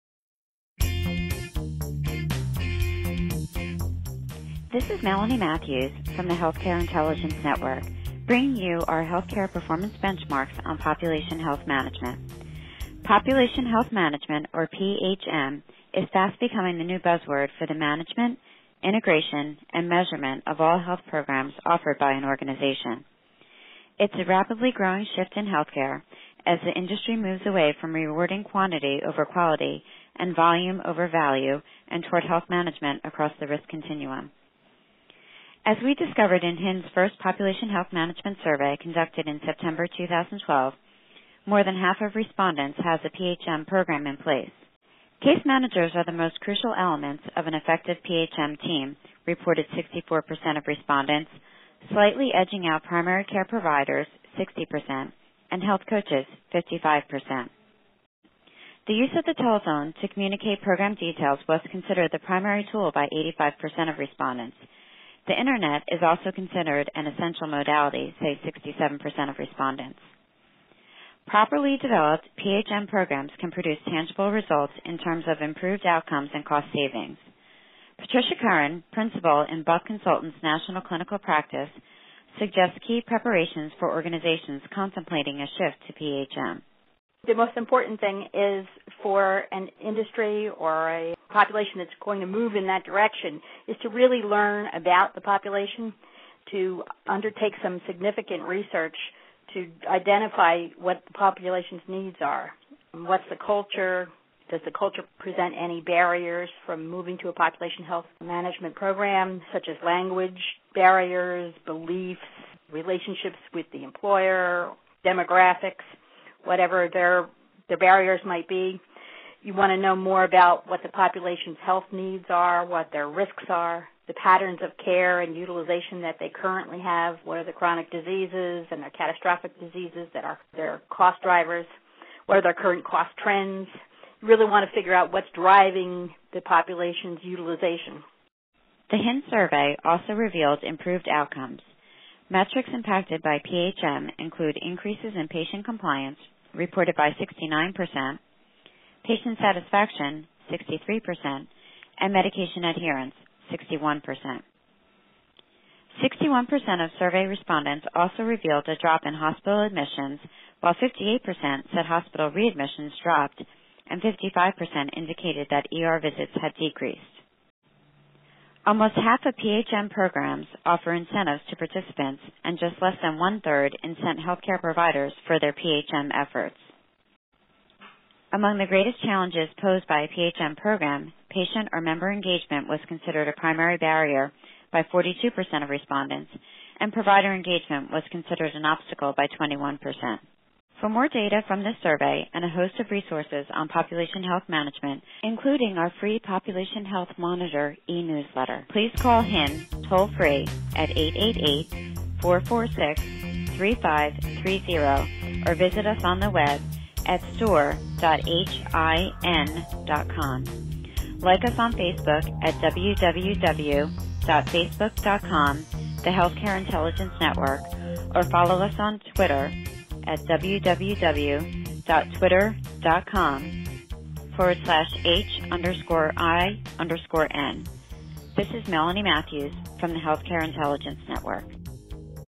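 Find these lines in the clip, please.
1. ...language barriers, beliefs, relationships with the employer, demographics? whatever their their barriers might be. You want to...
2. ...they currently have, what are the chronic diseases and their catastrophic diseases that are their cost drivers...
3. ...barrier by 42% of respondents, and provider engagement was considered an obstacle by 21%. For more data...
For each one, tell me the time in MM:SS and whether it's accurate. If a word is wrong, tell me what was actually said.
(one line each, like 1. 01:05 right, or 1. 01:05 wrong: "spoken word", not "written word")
1. 01:49 right
2. 02:06 right
3. 03:03 right.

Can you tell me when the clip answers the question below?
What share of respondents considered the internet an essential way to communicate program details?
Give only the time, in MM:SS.
01:08.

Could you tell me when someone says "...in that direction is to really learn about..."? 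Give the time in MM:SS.
01:32.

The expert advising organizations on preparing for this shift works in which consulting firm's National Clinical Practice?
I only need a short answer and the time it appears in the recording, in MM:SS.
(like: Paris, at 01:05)
Buck Consultants, at 01:19.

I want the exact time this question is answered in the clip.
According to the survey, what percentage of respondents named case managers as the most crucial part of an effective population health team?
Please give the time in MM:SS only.
00:49.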